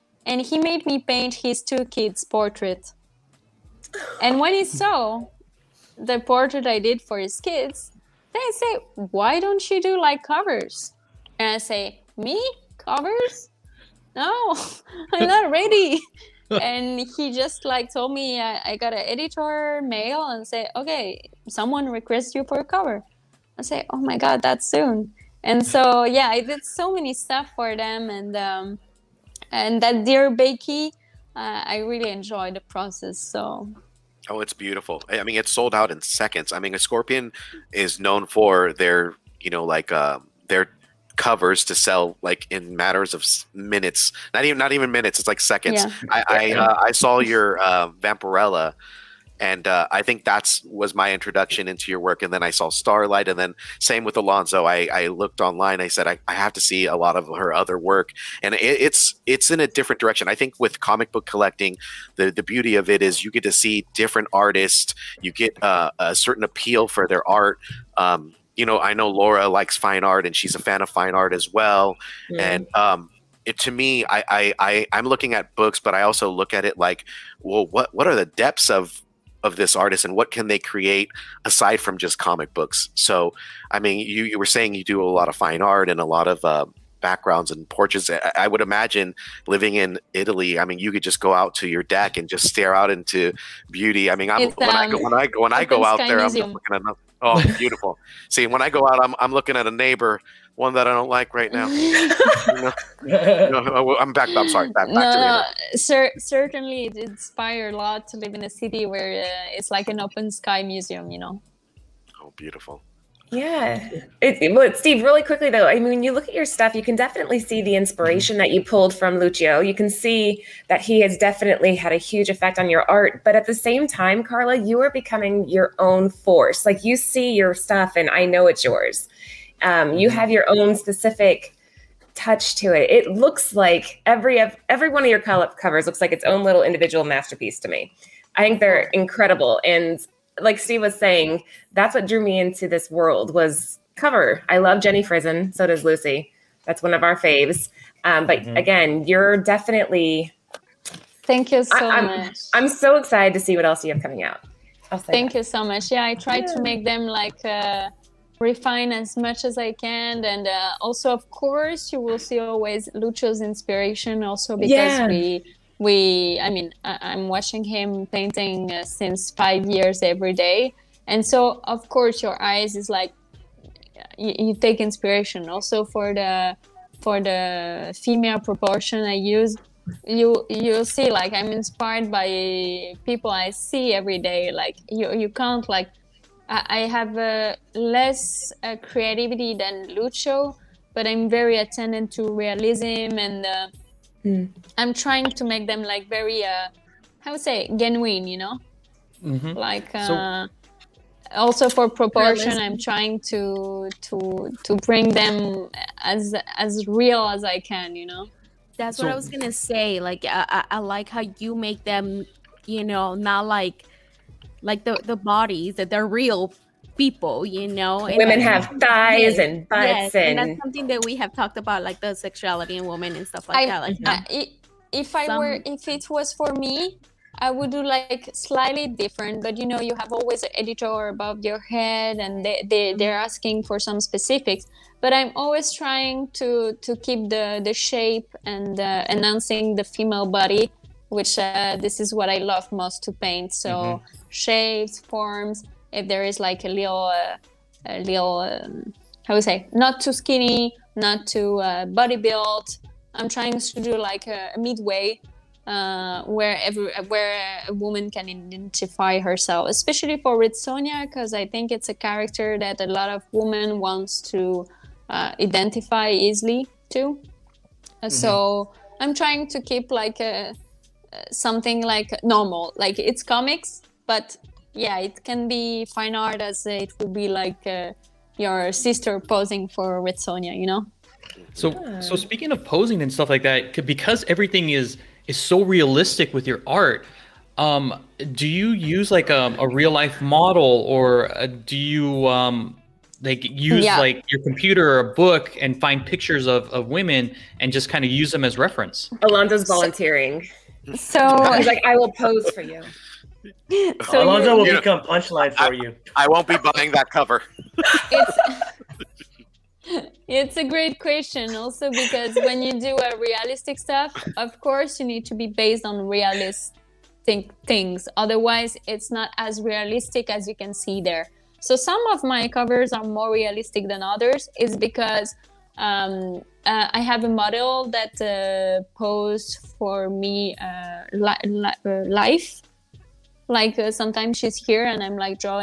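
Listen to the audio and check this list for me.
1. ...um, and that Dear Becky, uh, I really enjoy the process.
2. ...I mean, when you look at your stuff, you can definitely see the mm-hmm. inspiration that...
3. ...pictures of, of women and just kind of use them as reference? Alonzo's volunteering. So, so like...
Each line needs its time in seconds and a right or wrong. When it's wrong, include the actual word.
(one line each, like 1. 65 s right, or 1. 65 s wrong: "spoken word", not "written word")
1. 28 s right
2. 115 s right
3. 296 s right.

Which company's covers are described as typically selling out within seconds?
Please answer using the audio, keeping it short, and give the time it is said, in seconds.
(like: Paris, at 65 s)
Scorpion, at 36 s.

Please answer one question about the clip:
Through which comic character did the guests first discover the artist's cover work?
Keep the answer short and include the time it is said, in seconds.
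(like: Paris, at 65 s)
Vampirella, at 47 s.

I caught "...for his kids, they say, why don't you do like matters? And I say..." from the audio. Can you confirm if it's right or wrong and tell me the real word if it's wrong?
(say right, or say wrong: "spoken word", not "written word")
wrong: "covers", not "matters".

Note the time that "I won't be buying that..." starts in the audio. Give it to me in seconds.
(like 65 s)
306 s.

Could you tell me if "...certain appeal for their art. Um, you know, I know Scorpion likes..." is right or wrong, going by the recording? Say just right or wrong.
wrong.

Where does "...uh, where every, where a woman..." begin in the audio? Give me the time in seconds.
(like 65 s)
255 s.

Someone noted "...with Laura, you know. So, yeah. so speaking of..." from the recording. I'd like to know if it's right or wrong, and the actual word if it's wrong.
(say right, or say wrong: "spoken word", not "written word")
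wrong: "Sonja", not "Laura".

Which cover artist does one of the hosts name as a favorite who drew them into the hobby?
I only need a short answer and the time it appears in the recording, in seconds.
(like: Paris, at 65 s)
Jenny Frison, at 144 s.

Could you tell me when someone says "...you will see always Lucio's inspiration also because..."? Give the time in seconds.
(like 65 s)
161 s.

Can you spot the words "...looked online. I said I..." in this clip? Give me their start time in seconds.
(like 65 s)
55 s.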